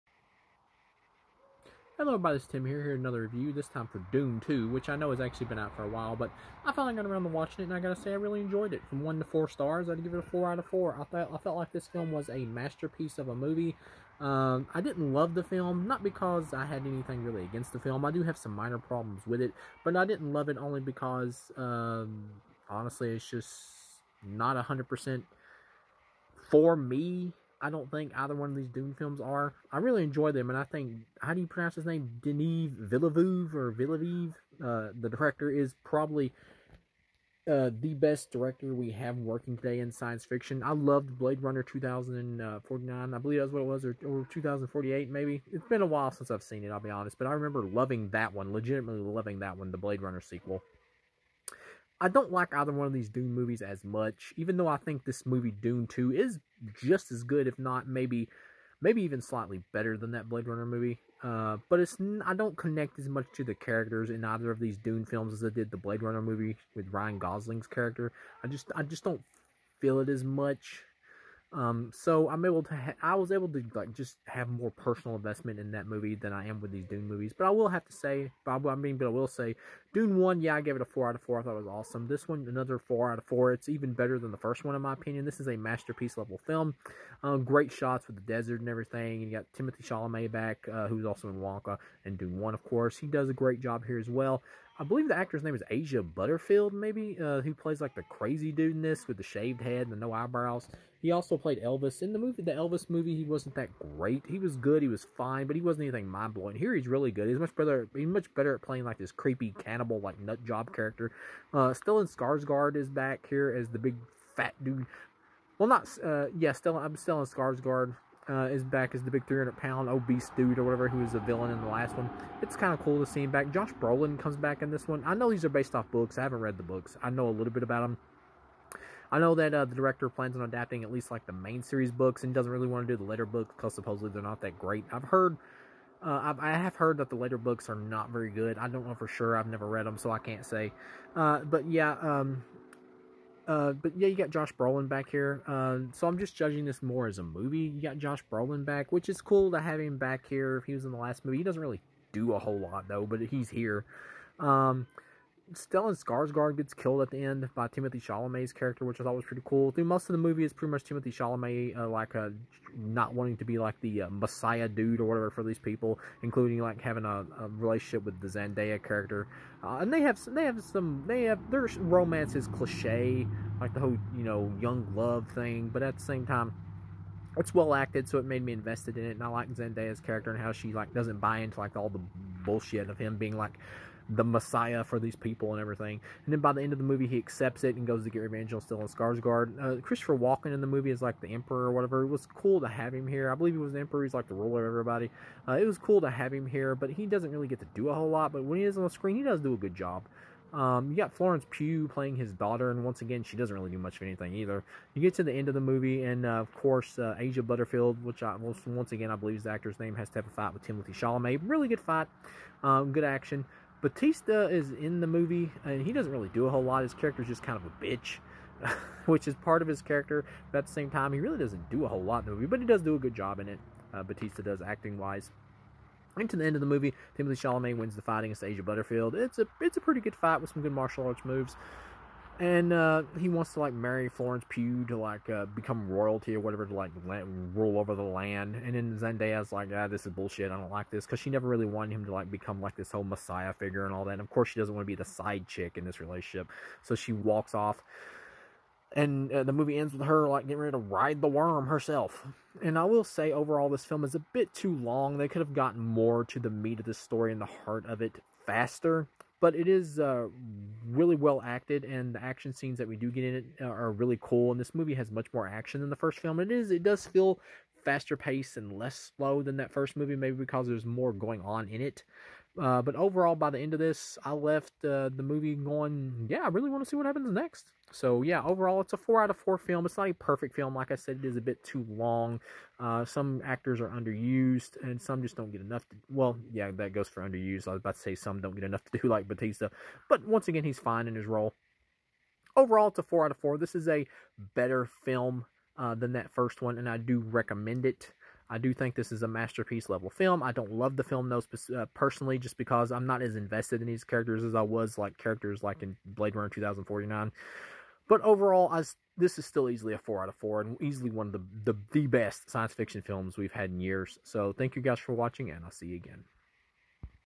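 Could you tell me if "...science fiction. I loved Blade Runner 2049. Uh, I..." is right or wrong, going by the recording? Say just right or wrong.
right.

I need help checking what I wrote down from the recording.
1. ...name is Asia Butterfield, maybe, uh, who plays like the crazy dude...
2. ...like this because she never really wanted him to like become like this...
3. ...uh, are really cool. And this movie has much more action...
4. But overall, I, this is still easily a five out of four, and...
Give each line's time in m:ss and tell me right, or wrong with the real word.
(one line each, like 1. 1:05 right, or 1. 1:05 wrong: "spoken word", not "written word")
1. 1:35 right
2. 4:00 right
3. 4:23 right
4. 5:08 wrong: "four", not "five".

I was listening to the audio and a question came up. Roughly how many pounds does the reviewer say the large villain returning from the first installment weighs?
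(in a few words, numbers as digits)
300.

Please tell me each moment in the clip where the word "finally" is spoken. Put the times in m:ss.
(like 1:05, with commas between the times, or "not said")
0:06.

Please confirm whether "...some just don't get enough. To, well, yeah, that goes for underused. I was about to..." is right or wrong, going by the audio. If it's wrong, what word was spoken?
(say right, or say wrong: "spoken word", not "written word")
right.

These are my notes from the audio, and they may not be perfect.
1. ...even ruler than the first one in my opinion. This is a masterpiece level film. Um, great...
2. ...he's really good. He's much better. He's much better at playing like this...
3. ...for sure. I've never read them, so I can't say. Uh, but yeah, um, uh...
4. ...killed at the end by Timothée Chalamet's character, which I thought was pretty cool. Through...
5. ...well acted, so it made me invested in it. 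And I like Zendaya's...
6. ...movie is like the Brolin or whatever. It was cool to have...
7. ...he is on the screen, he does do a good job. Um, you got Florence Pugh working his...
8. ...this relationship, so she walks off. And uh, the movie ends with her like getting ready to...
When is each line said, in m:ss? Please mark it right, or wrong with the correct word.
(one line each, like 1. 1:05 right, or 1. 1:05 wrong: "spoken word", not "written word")
1. 1:23 wrong: "better", not "ruler"
2. 1:46 right
3. 2:18 right
4. 2:36 right
5. 2:57 right
6. 3:10 wrong: "Emperor", not "Brolin"
7. 3:18 wrong: "playing", not "working"
8. 4:05 right.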